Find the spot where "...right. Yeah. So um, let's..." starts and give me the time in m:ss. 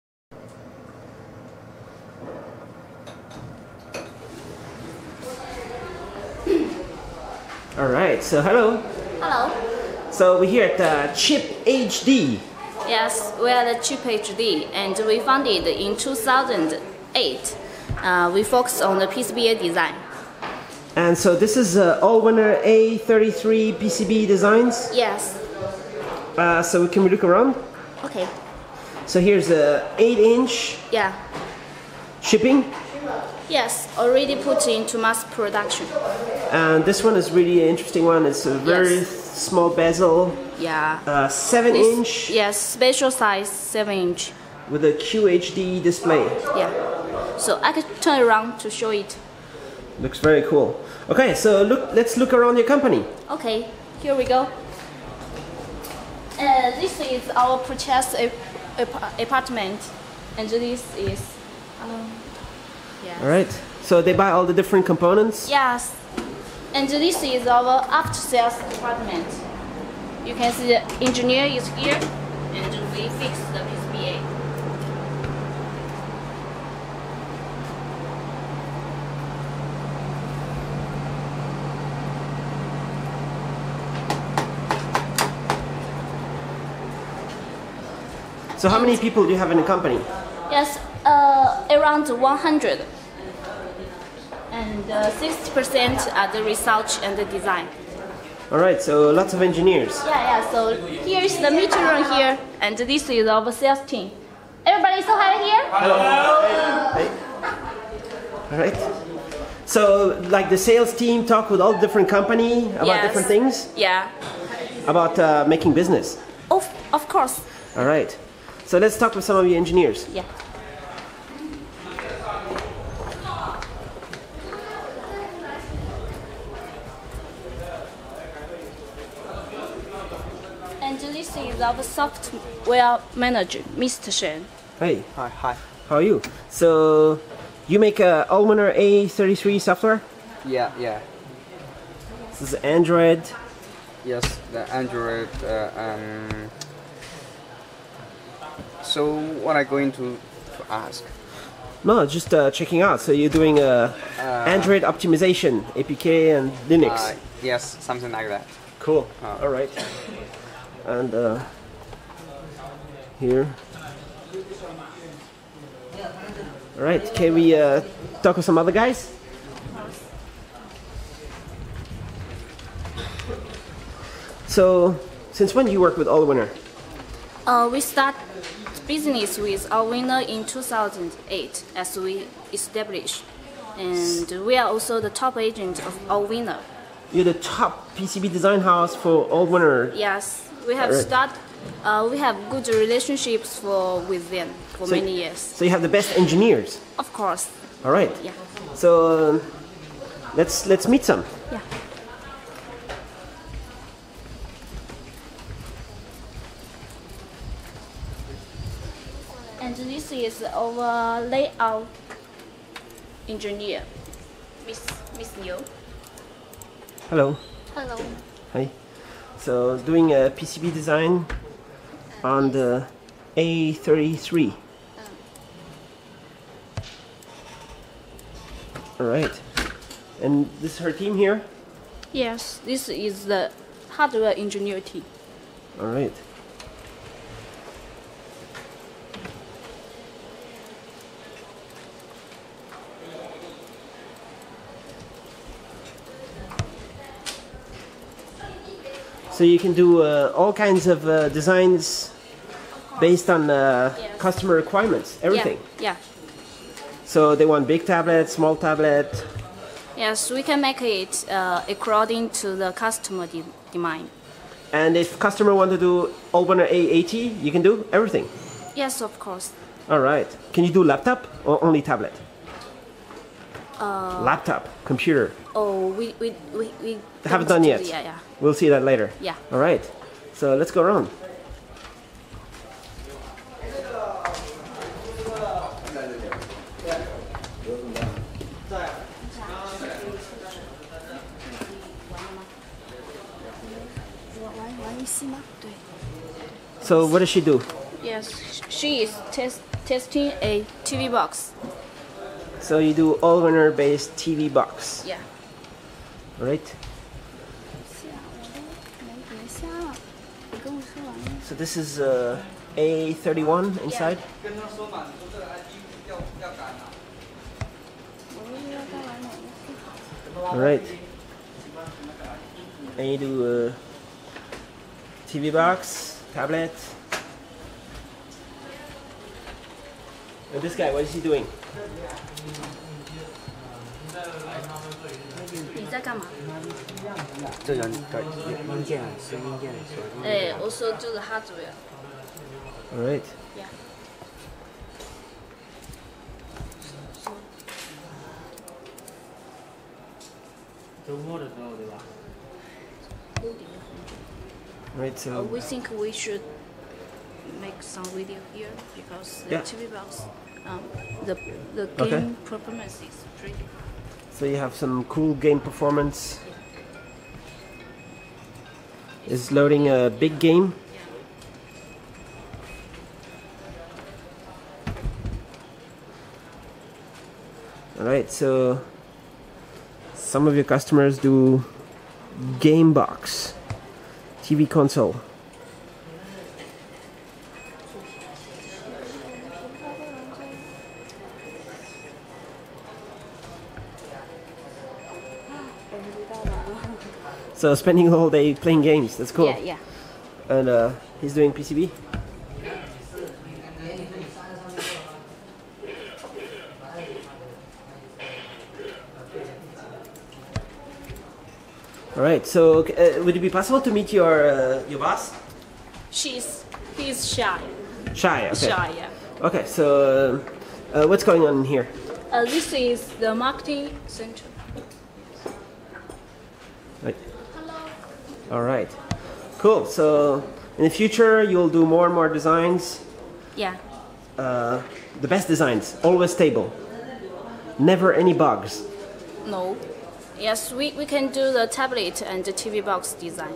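3:17.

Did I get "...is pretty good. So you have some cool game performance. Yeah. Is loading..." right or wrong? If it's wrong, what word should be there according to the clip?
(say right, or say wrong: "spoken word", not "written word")
right.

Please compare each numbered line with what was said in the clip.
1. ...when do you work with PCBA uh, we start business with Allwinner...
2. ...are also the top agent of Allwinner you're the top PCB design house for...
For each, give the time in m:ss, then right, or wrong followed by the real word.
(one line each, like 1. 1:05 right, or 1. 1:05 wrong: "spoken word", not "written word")
1. 2:55 wrong: "Allwinner", not "PCBA"
2. 3:04 right.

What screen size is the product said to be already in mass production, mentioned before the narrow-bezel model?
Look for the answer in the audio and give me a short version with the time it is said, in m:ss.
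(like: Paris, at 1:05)
8 inch, at 0:29.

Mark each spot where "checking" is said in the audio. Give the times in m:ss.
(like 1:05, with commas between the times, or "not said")
2:32.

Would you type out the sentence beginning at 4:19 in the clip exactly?
Yes, we can make it uh, according to the customer de demand.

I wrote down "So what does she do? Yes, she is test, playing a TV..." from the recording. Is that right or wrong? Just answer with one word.
wrong.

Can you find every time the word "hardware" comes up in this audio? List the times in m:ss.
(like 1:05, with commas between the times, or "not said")
3:53, 5:41.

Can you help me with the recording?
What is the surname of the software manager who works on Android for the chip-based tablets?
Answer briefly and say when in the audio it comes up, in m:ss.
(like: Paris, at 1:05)
Shen, at 2:13.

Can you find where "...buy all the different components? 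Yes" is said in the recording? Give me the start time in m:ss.
1:04.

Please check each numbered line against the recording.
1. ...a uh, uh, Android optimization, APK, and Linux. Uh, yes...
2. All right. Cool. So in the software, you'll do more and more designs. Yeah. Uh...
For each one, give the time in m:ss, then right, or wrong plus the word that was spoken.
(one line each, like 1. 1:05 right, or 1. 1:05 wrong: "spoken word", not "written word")
1. 2:33 right
2. 7:08 wrong: "future", not "software".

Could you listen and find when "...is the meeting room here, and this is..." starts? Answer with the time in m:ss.
1:41.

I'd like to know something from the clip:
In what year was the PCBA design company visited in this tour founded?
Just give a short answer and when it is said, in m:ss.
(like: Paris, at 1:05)
2008, at 0:15.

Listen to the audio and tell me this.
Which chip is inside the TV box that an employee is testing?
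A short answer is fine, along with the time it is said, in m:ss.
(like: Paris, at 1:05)
A31, at 5:12.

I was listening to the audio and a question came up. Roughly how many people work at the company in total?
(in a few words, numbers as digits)
100.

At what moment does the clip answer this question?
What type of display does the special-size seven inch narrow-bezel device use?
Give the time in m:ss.
0:44.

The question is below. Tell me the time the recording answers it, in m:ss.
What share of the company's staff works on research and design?
1:34.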